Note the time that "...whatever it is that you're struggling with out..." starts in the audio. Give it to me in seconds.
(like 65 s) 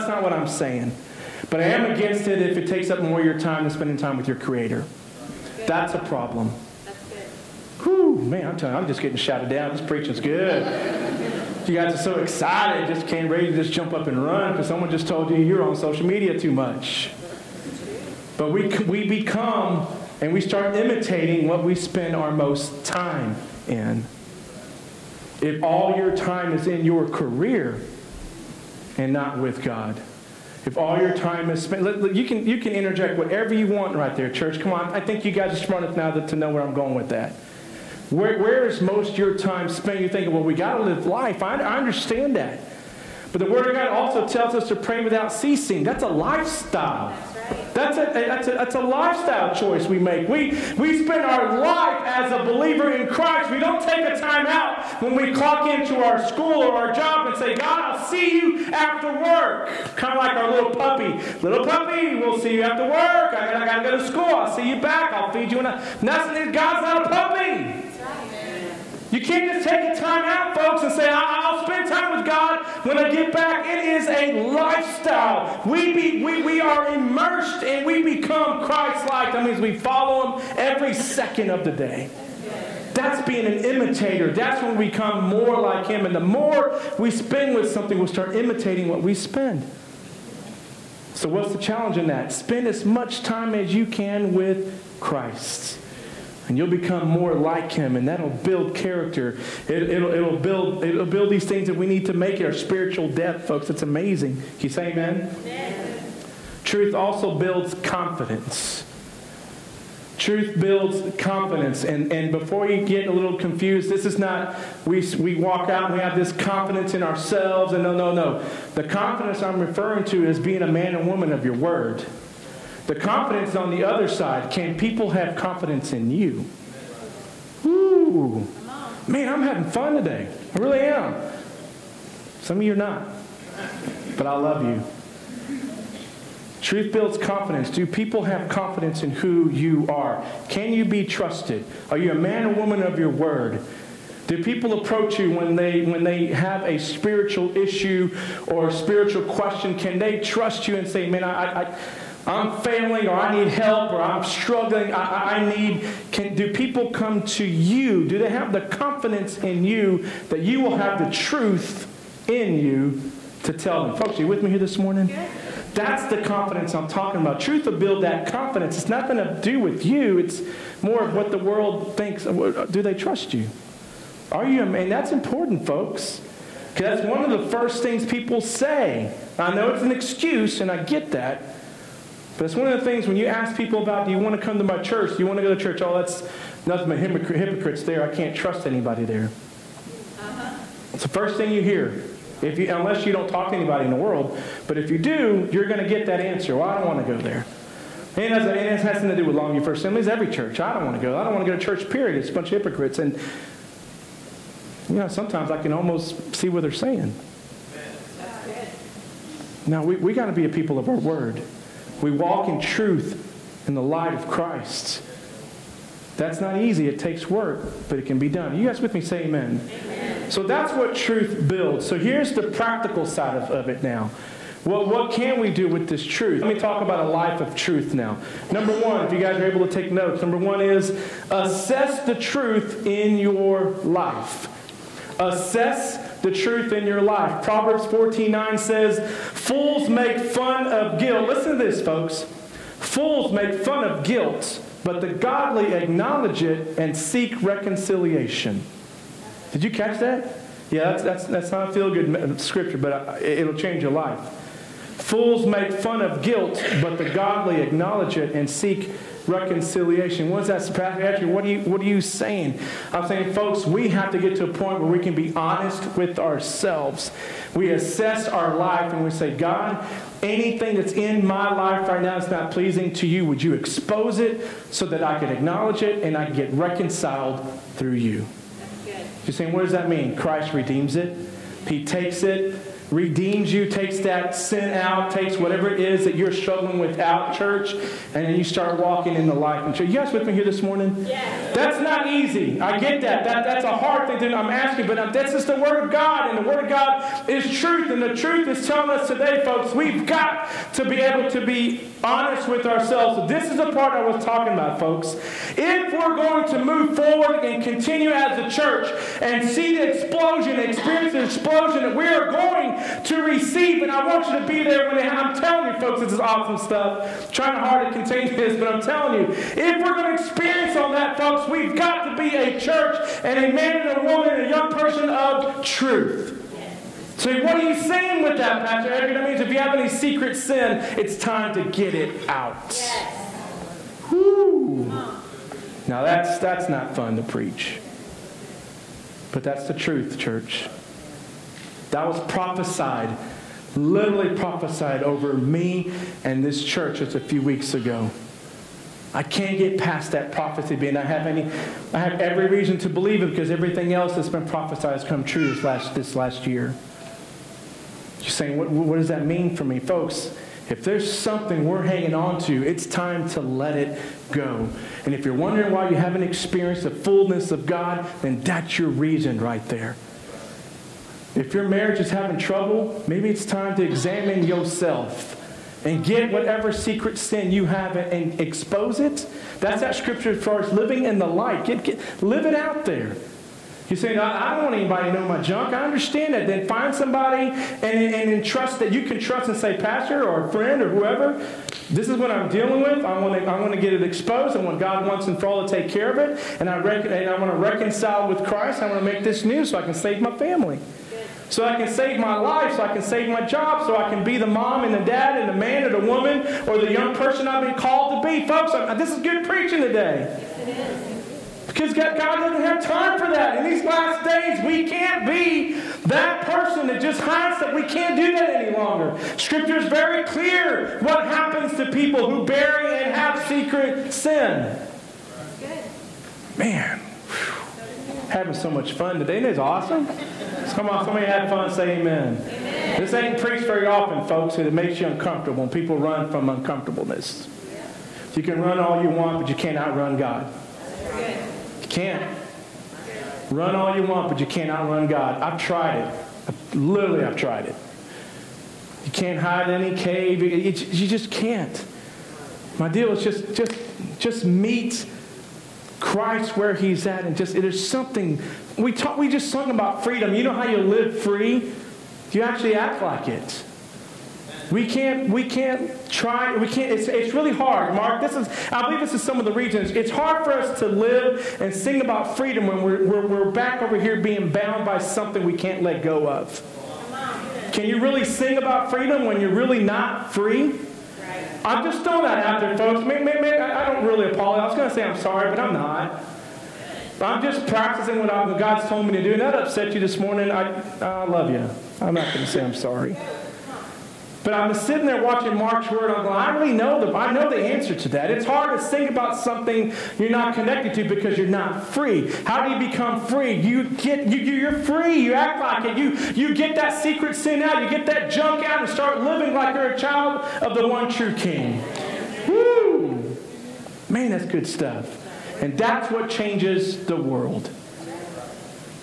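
285 s.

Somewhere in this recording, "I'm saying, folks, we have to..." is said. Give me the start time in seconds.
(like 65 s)
262 s.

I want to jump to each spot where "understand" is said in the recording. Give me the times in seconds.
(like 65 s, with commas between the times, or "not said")
41 s, 385 s.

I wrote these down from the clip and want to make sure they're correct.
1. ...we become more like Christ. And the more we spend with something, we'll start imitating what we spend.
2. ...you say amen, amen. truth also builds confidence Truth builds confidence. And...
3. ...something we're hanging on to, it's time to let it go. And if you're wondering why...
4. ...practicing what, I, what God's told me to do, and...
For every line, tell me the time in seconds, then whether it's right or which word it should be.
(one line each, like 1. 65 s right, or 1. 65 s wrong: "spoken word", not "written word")
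1. 84 s wrong: "Him", not "Christ"
2. 104 s right
3. 361 s right
4. 487 s right.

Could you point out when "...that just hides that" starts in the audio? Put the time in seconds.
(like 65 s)
416 s.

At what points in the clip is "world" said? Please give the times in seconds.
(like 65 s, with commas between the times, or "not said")
171 s, 193 s, 517 s.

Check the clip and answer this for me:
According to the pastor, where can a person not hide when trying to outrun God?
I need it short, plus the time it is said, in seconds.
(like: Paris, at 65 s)
cave, at 449 s.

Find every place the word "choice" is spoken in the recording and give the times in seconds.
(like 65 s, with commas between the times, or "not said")
49 s.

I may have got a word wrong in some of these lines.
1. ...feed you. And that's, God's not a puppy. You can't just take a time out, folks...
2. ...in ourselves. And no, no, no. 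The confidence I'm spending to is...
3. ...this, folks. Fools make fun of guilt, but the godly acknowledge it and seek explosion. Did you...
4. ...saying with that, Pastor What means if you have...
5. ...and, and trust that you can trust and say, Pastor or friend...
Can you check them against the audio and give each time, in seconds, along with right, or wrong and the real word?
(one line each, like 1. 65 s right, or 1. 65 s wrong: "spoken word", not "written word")
1. 65 s right
2. 116 s wrong: "referring", not "spending"
3. 241 s wrong: "reconciliation", not "explosion"
4. 327 s wrong: "That", not "What"
5. 387 s right.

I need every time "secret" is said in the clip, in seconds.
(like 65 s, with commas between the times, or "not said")
329 s, 376 s, 423 s, 507 s.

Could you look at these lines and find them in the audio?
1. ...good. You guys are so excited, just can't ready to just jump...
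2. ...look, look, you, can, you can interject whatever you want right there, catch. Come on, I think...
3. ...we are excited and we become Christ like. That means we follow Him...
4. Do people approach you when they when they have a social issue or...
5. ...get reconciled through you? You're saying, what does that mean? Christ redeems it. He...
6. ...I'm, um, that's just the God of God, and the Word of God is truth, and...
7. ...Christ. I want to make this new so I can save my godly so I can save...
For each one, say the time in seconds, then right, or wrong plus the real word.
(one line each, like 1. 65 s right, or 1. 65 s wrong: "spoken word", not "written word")
1. 10 s right
2. 31 s wrong: "church", not "catch"
3. 76 s wrong: "immersed", not "excited"
4. 144 s wrong: "spiritual", not "social"
5. 276 s right
6. 294 s wrong: "Word", not "God"
7. 398 s wrong: "family", not "godly".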